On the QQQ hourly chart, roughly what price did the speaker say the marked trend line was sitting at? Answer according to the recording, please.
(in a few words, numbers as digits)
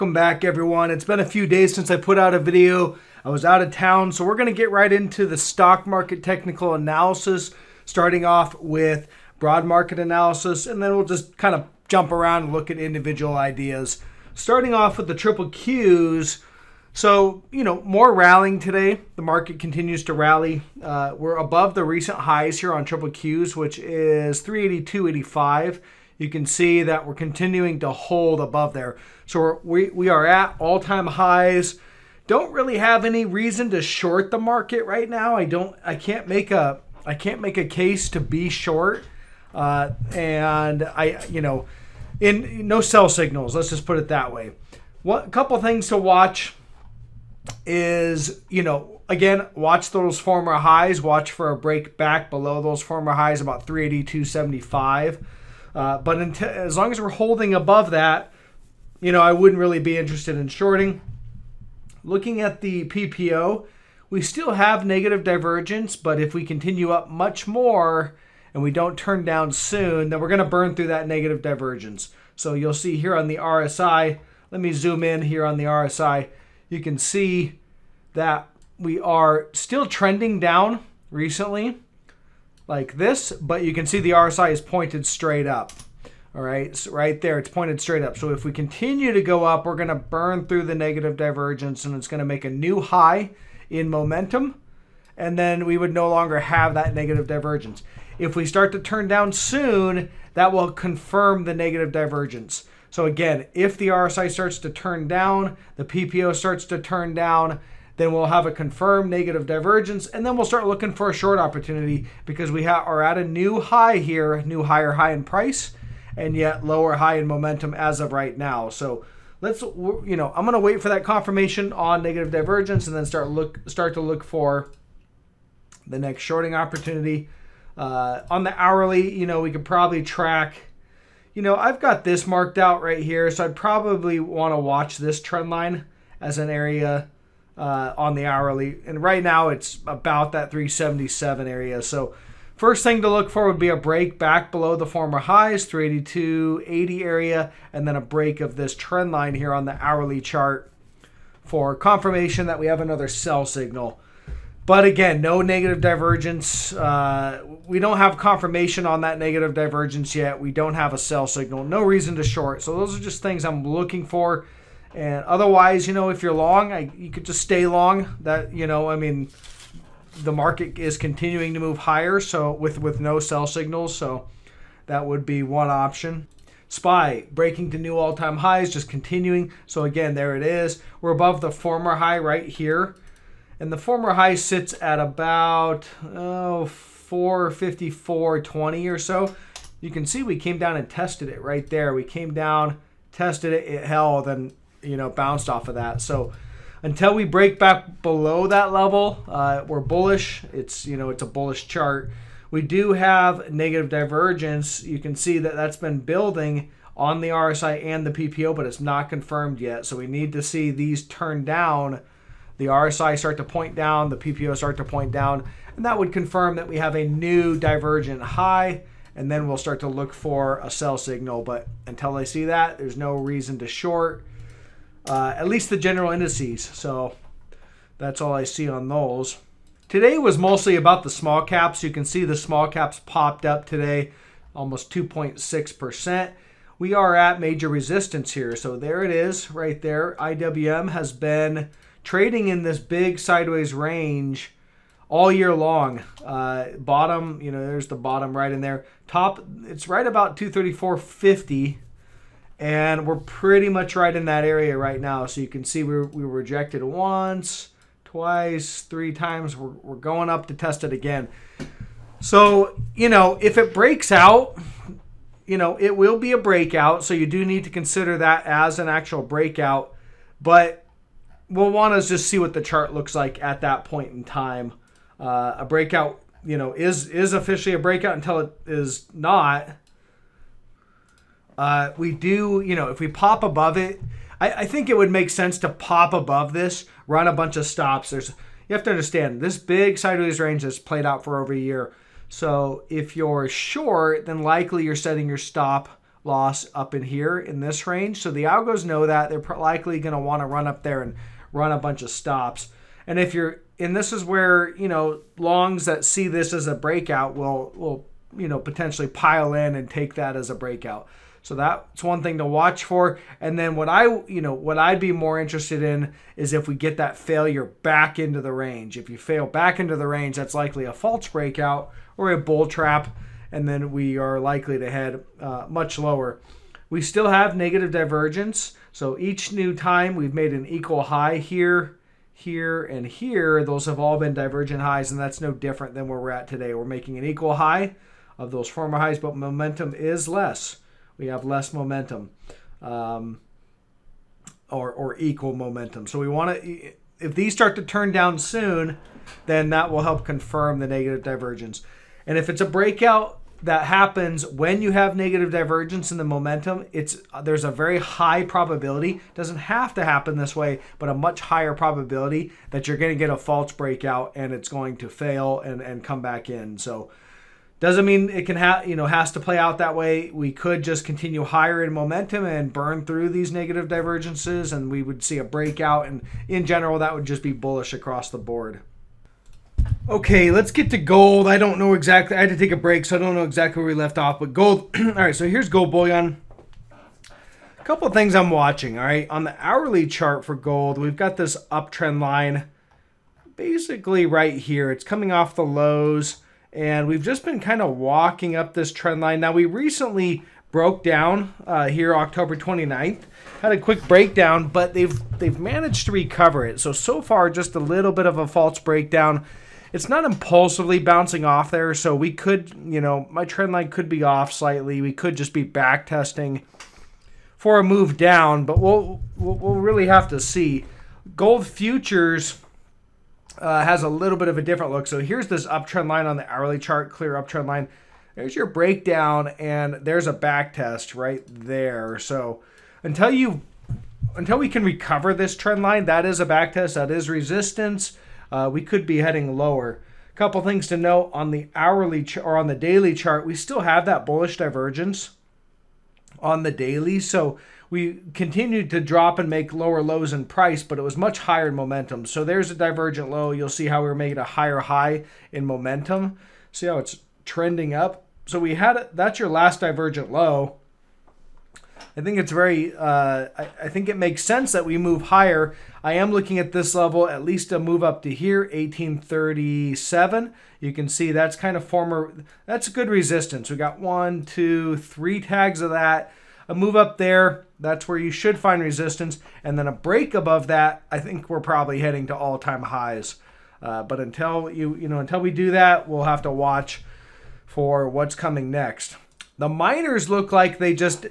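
377.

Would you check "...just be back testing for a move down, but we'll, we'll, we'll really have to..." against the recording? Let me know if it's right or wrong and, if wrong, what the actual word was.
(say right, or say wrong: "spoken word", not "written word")
right.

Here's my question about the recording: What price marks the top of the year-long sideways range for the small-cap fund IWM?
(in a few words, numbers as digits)
234.50.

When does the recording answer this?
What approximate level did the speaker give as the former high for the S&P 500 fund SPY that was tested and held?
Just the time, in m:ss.
3:07.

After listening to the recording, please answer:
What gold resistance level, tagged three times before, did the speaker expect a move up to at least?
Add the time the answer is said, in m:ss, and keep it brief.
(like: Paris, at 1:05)
1837, at 7:48.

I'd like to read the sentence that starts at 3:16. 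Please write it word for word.
So until we break back below that level, uh, we're bullish.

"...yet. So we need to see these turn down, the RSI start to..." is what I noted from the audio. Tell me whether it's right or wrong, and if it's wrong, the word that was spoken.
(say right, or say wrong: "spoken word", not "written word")
right.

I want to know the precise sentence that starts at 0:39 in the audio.
Uh, and I, you know, in no sell signals.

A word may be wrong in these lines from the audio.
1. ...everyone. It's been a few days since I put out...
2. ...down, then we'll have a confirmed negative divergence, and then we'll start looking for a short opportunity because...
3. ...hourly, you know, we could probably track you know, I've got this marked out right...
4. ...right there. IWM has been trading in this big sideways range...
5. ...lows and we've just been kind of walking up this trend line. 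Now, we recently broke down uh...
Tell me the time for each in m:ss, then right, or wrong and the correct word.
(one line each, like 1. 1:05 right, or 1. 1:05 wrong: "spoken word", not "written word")
1. 0:00 right
2. 1:47 right
3. 2:08 right
4. 3:59 right
5. 6:35 right.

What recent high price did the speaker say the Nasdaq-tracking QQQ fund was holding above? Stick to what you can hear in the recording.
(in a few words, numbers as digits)
382.85.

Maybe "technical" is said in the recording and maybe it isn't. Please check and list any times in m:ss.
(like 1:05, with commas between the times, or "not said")
0:06.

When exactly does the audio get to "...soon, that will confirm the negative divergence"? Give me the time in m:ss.
1:39.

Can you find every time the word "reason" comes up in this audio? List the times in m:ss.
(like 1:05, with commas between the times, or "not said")
0:33, 2:41, 3:43.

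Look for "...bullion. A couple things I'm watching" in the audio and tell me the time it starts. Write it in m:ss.
6:25.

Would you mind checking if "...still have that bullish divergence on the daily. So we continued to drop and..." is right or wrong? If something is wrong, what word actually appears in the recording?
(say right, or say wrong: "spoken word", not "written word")
right.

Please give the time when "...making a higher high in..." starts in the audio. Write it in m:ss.
7:34.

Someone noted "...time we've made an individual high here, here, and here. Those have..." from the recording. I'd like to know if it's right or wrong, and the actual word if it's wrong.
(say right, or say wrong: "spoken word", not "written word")
wrong: "equal", not "individual".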